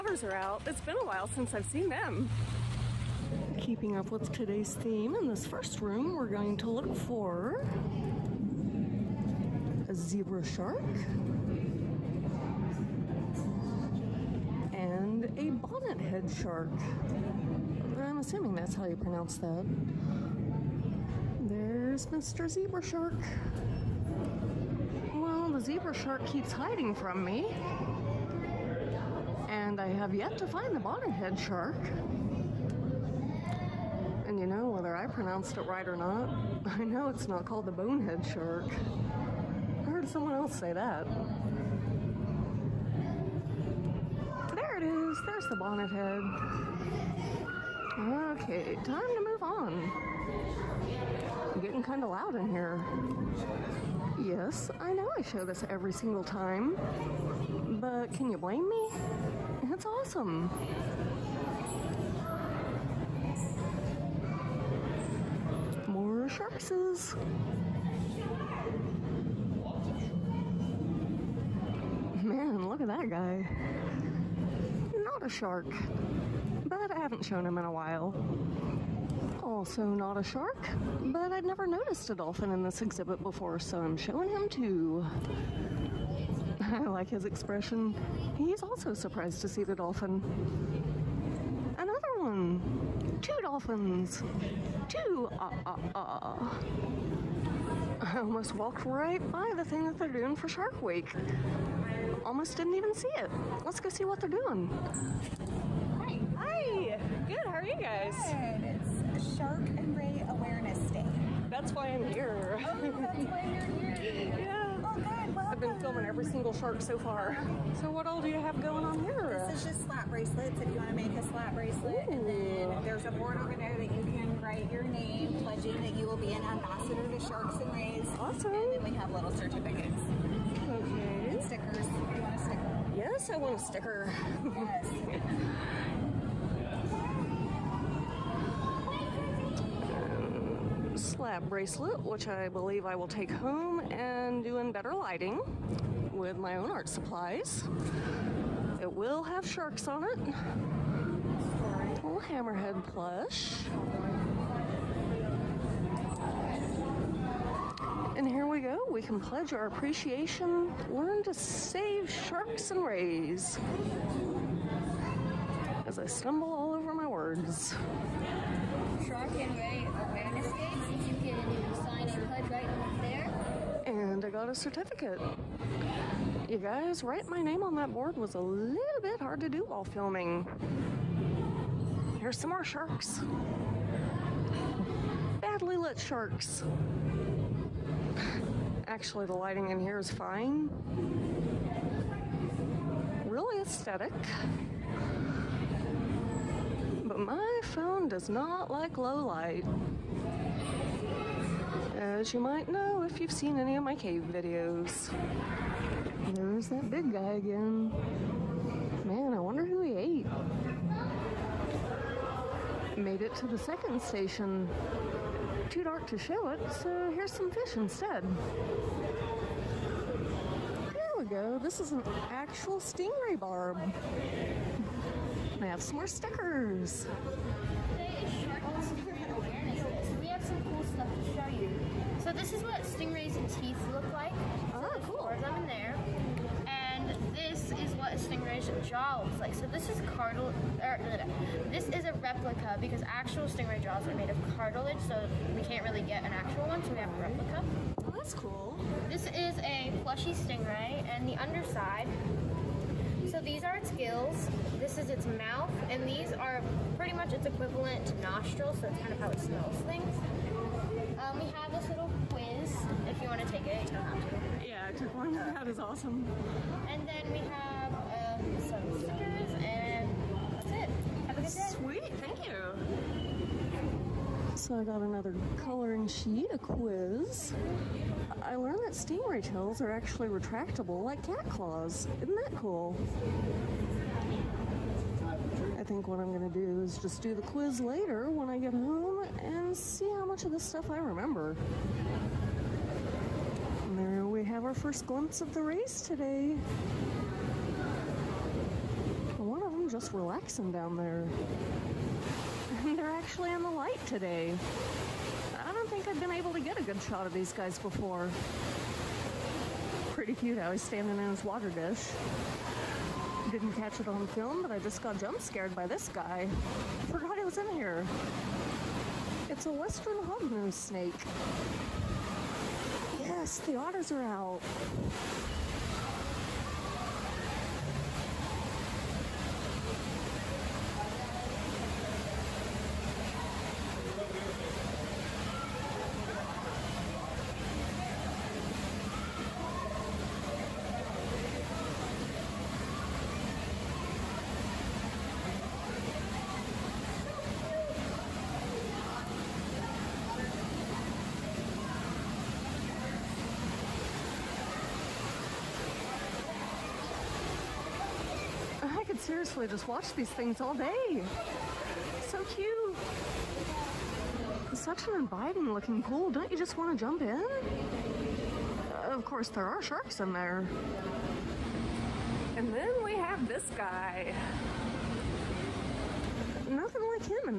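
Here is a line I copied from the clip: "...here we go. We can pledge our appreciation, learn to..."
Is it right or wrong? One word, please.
right.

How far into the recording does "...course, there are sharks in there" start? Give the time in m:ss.
6:09.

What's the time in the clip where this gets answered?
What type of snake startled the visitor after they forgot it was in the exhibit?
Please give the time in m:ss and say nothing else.
5:19.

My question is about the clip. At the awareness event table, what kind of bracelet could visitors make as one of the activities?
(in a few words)
Slap bracelets.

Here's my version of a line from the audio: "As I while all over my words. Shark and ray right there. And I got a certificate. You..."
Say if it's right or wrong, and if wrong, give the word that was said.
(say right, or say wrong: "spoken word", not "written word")
wrong: "stumble", not "while".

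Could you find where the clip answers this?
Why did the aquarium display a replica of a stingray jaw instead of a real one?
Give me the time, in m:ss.
4:04.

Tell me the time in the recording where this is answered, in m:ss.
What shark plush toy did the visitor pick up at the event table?
2:32.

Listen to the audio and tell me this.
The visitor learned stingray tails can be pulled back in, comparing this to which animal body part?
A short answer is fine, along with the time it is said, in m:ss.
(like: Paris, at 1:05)
Cat claws, at 4:41.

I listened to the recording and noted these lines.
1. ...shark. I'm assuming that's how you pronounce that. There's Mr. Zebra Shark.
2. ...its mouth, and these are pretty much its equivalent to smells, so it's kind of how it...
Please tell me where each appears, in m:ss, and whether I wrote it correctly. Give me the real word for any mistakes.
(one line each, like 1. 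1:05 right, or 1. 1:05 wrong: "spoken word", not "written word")
1. 0:16 right
2. 4:15 wrong: "nostrils", not "smells".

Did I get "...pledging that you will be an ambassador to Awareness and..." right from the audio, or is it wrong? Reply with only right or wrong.
wrong.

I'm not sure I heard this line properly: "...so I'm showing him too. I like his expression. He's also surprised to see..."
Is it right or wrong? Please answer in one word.
right.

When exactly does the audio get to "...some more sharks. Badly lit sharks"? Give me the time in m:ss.
3:02.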